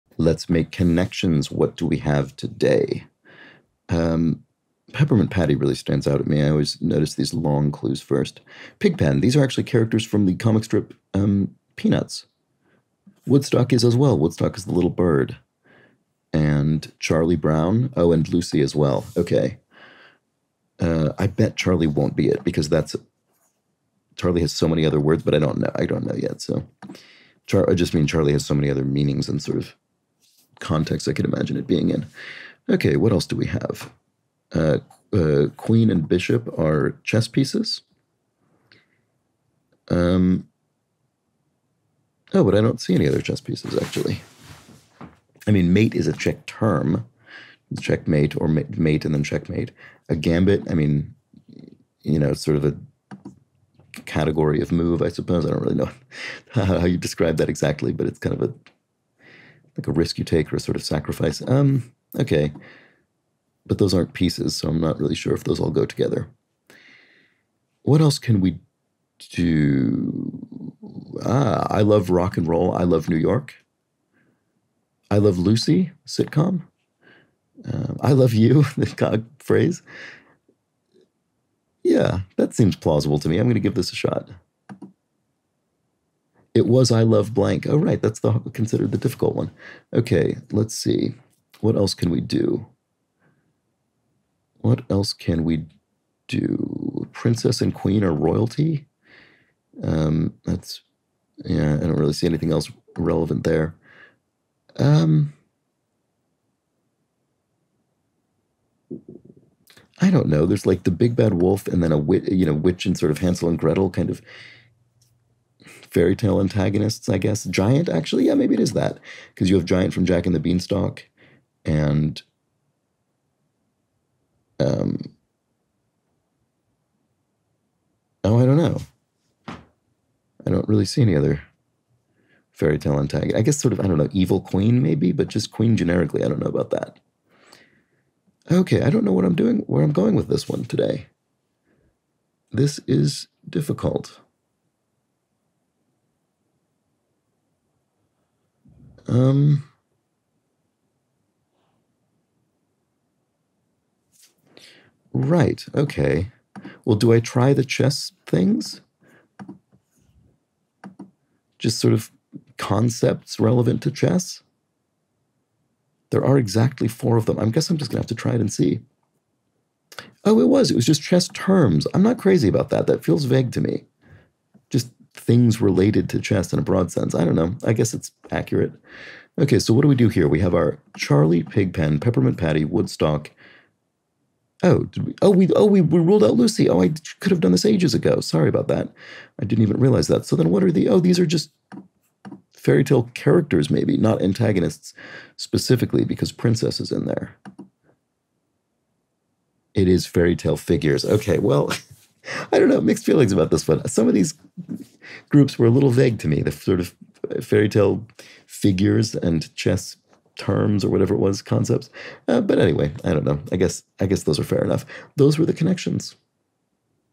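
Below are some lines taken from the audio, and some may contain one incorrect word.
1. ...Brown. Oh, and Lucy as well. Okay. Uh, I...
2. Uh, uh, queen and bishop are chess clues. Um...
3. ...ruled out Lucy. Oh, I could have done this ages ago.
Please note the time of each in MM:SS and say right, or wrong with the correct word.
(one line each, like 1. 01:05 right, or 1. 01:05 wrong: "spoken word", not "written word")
1. 00:17 right
2. 00:34 wrong: "pieces", not "clues"
3. 03:05 right.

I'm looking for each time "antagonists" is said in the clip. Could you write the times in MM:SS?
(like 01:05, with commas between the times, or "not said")
01:56, 02:12, 03:14.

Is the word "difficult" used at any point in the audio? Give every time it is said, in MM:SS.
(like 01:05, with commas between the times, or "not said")
01:28, 02:23.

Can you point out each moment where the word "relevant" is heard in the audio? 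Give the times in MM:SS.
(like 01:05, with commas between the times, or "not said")
01:42, 02:43.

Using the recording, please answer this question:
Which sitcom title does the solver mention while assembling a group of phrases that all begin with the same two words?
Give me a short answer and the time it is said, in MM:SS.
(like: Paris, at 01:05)
I Love Lucy, at 01:15.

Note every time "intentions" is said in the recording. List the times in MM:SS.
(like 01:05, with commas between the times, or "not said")
not said.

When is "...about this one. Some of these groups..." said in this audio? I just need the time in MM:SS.
03:23.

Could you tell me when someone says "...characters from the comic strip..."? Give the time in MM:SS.
00:09.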